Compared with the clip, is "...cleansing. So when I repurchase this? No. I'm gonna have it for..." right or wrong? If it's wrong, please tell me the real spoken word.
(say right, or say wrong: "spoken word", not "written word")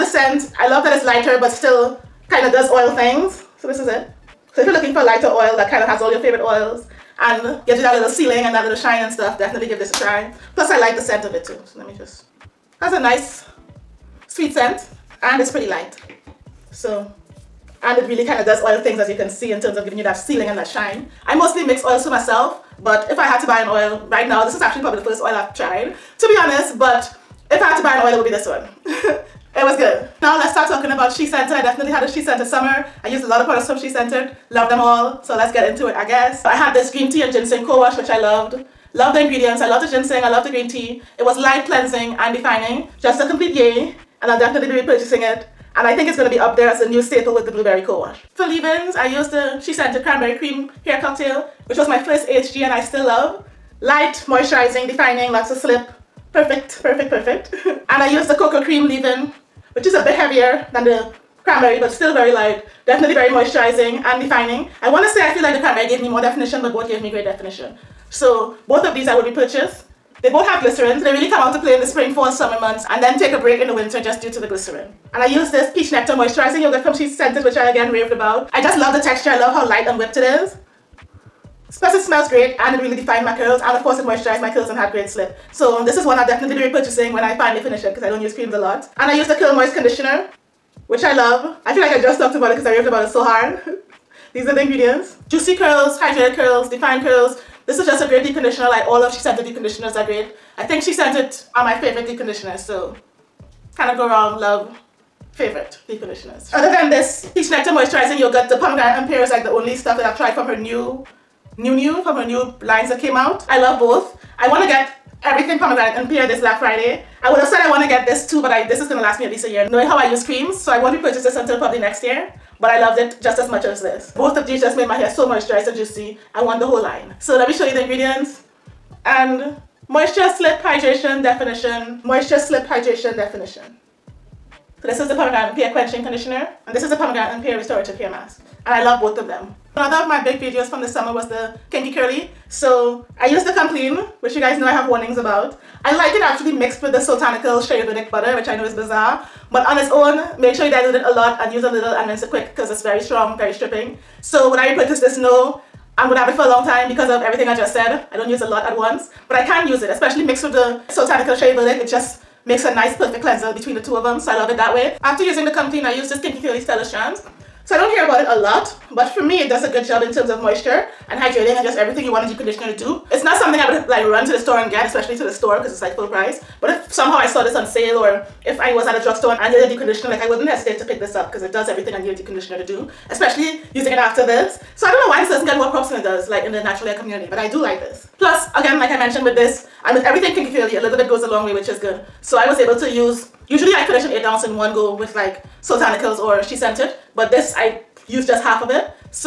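wrong: "stripping", not "cleansing".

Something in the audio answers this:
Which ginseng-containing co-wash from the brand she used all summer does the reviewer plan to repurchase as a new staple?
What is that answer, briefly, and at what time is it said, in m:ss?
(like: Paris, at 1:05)
green tea and ginseng co-wash, at 0:36.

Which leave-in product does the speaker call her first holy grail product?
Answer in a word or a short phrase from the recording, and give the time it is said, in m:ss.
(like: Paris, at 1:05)
Cranberry Cream Hair Cocktail, at 0:50.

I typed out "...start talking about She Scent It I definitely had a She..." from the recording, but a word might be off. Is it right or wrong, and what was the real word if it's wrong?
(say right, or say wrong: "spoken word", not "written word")
right.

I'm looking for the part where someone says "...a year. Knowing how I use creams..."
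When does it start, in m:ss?
1:59.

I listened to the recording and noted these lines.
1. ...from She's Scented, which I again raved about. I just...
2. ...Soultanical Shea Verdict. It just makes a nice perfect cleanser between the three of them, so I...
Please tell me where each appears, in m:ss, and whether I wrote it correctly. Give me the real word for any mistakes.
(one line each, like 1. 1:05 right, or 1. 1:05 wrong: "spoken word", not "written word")
1. 1:16 right
2. 2:40 wrong: "two", not "three".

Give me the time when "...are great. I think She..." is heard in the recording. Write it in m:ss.
1:39.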